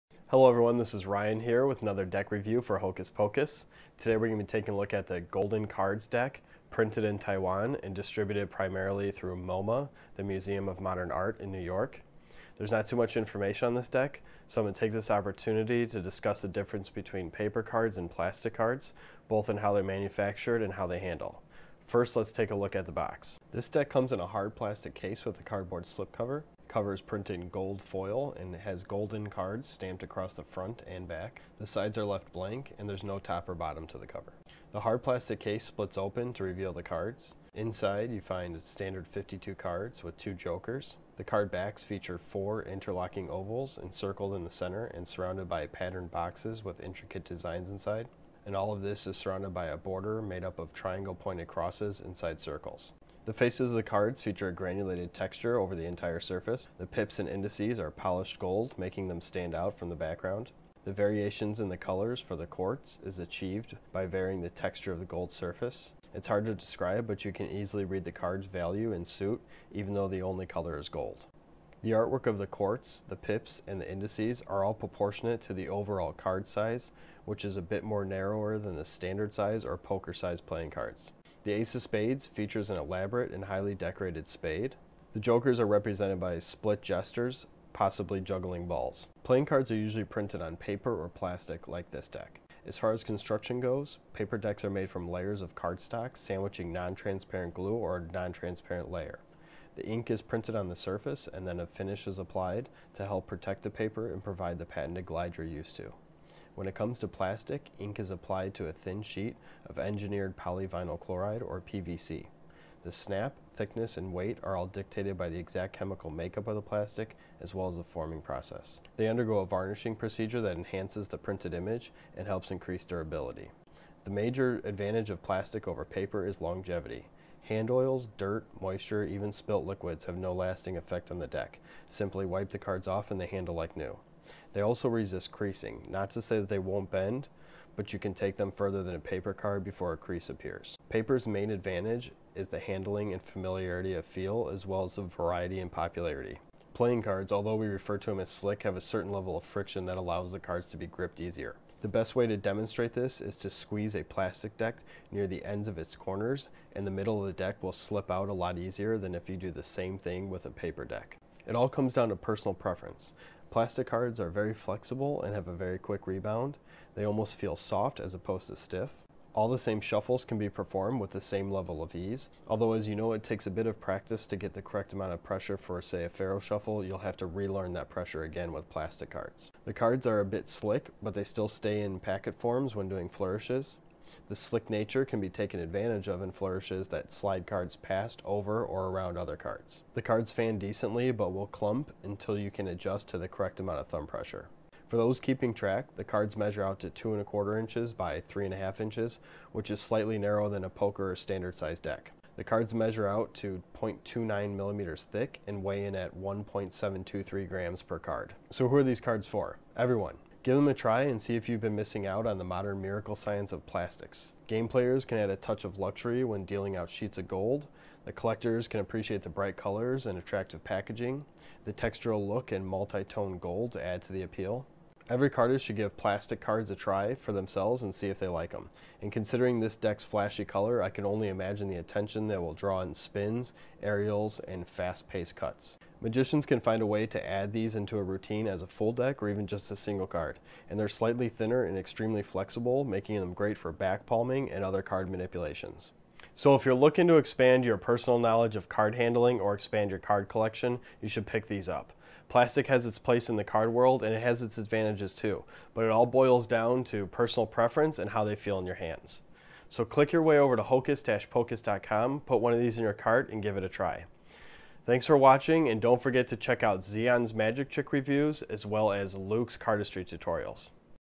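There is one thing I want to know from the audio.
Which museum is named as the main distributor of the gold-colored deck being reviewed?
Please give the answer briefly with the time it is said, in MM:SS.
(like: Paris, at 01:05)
Museum of Modern Art, at 00:10.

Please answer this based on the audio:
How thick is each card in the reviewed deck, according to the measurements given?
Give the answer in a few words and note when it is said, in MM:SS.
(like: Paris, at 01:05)
0.29 millimeters, at 03:23.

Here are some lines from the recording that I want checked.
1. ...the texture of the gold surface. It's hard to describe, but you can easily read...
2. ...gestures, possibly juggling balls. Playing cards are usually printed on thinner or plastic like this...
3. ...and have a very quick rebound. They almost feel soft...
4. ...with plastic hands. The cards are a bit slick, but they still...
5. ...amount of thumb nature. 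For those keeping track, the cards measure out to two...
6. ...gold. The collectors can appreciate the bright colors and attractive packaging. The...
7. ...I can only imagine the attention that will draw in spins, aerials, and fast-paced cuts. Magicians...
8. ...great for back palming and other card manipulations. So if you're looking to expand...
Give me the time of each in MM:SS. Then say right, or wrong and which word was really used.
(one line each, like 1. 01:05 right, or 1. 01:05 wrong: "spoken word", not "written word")
1. 01:04 right
2. 01:26 wrong: "paper", not "thinner"
3. 02:45 right
4. 02:58 wrong: "cards", not "hands"
5. 03:13 wrong: "pressure", not "nature"
6. 03:37 right
7. 03:50 right
8. 04:03 right.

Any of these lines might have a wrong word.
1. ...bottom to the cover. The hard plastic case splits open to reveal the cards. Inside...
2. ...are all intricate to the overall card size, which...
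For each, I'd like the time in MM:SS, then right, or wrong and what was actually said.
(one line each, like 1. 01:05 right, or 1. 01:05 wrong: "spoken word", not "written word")
1. 00:33 right
2. 01:14 wrong: "proportionate", not "intricate".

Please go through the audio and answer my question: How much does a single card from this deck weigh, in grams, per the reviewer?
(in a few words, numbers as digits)
1.723 grams.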